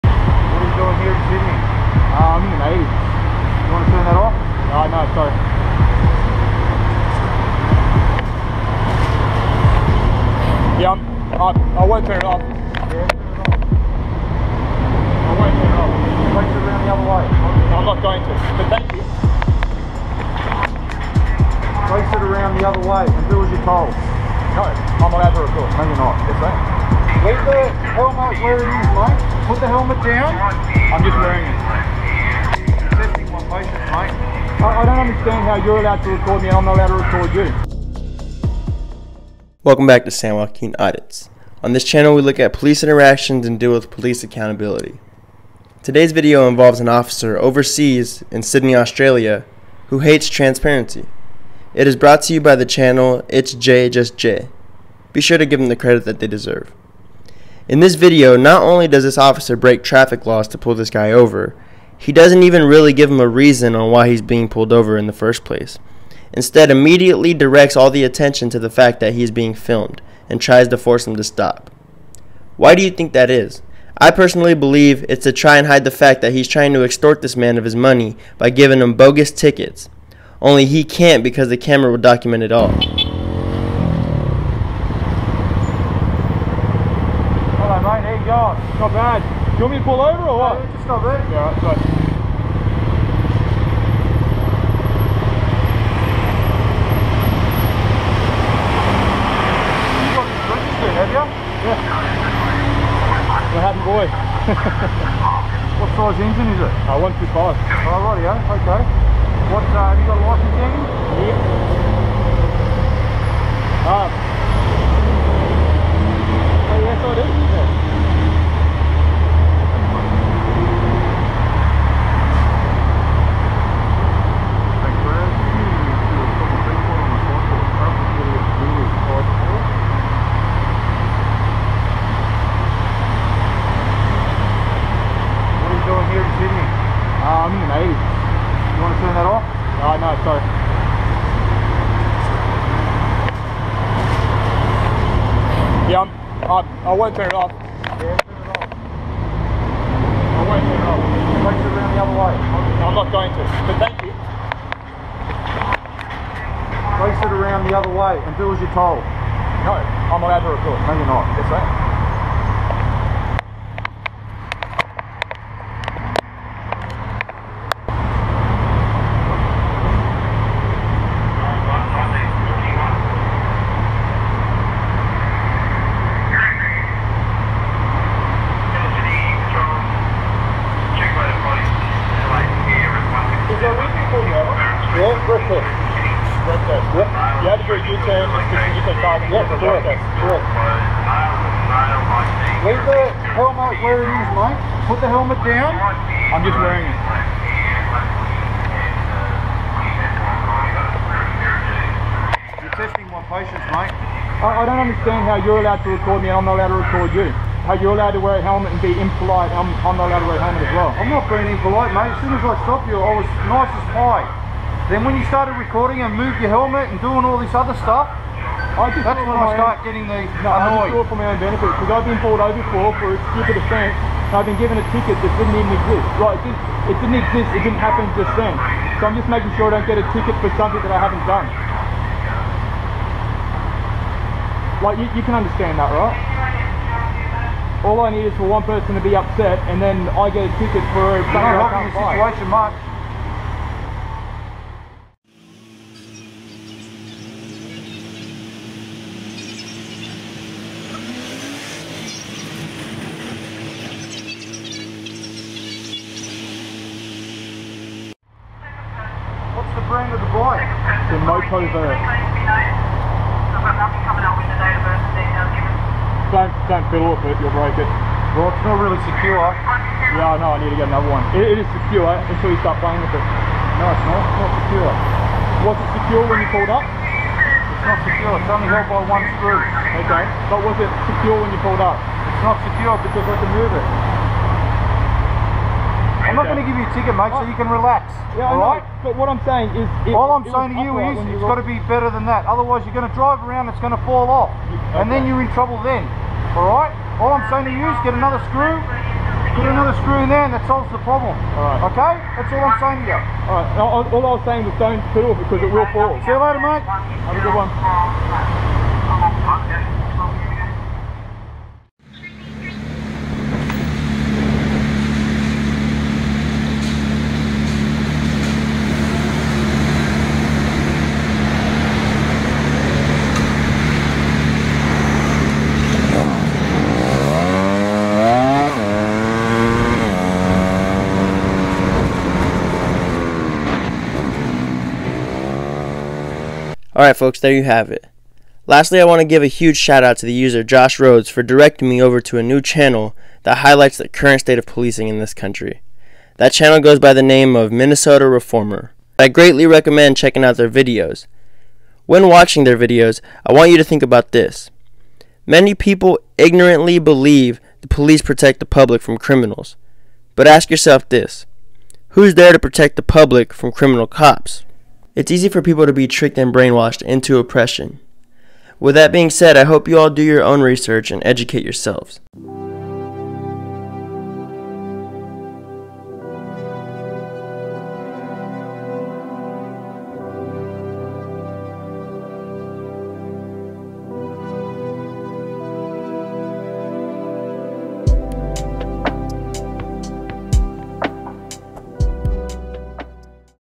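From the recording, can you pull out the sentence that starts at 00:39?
Welcome back to San Joaquin Audits.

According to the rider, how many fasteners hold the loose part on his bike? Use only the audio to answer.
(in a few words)
one screw.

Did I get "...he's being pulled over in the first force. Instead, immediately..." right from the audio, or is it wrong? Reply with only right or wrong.
wrong.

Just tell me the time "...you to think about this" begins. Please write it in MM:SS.
05:53.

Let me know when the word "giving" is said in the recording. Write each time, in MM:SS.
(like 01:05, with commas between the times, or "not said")
01:18.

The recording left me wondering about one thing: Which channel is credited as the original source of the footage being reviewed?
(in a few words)
It's Jay Just Jay.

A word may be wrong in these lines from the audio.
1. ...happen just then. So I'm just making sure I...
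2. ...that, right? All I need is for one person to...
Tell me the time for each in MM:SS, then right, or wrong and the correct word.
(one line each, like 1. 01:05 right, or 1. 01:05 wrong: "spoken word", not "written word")
1. 03:47 right
2. 03:55 right.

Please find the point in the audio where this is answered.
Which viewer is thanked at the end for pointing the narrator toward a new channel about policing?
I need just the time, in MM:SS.
05:40.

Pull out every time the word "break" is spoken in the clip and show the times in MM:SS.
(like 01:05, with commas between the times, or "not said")
00:59, 04:27.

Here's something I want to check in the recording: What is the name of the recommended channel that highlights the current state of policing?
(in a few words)
Minnesota Reformer.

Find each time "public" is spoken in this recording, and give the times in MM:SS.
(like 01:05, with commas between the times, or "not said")
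05:58, 06:03.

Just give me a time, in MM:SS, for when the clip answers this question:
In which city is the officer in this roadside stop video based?
00:48.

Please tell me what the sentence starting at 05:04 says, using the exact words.
All I was saying was don't fiddle because it will fall.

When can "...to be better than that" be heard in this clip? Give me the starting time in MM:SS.
04:51.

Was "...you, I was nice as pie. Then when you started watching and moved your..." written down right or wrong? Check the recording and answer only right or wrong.
wrong.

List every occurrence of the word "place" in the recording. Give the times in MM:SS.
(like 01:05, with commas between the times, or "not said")
01:05, 02:37.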